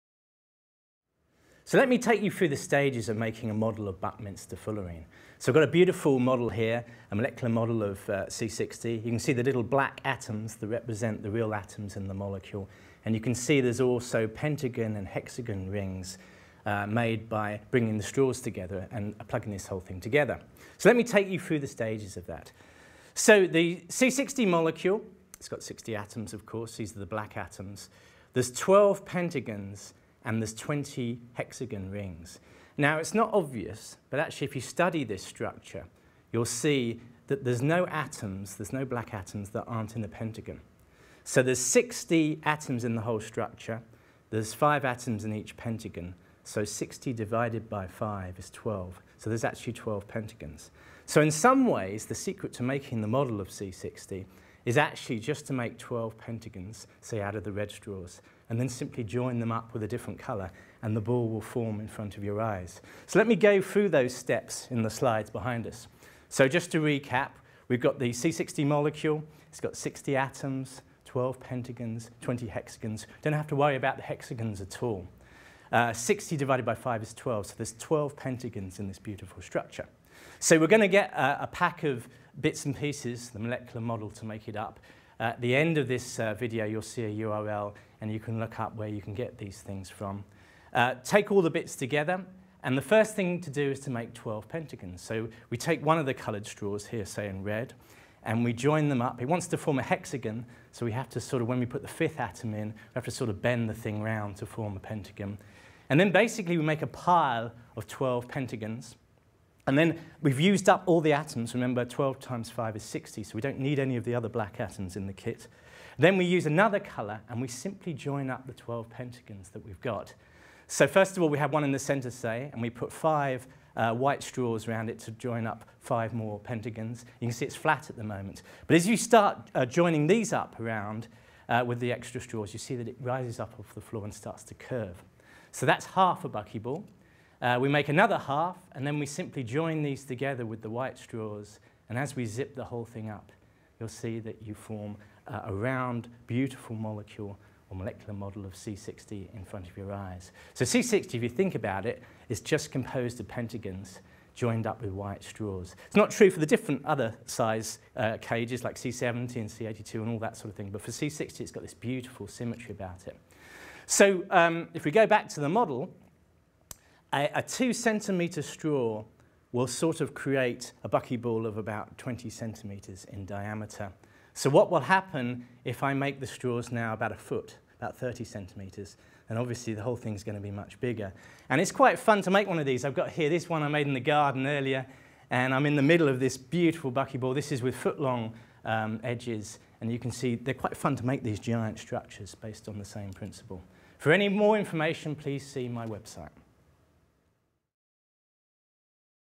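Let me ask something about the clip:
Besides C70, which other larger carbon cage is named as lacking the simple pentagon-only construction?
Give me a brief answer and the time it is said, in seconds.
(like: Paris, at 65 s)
C82, at 159 s.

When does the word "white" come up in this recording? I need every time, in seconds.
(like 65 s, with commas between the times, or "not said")
123 s, 140 s, 154 s.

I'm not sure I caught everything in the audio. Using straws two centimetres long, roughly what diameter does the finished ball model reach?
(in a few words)
20 centimetres.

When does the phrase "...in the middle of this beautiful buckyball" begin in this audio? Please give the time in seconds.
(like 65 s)
185 s.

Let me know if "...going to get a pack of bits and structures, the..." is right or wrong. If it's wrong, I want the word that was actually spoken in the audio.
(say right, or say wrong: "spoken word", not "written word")
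wrong: "pieces", not "structures".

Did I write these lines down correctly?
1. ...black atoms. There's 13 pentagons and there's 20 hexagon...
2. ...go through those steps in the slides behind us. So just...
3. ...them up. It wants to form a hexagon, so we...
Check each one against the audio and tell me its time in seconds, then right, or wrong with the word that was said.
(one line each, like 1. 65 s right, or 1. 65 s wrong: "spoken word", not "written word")
1. 27 s wrong: "12", not "13"
2. 63 s right
3. 98 s right.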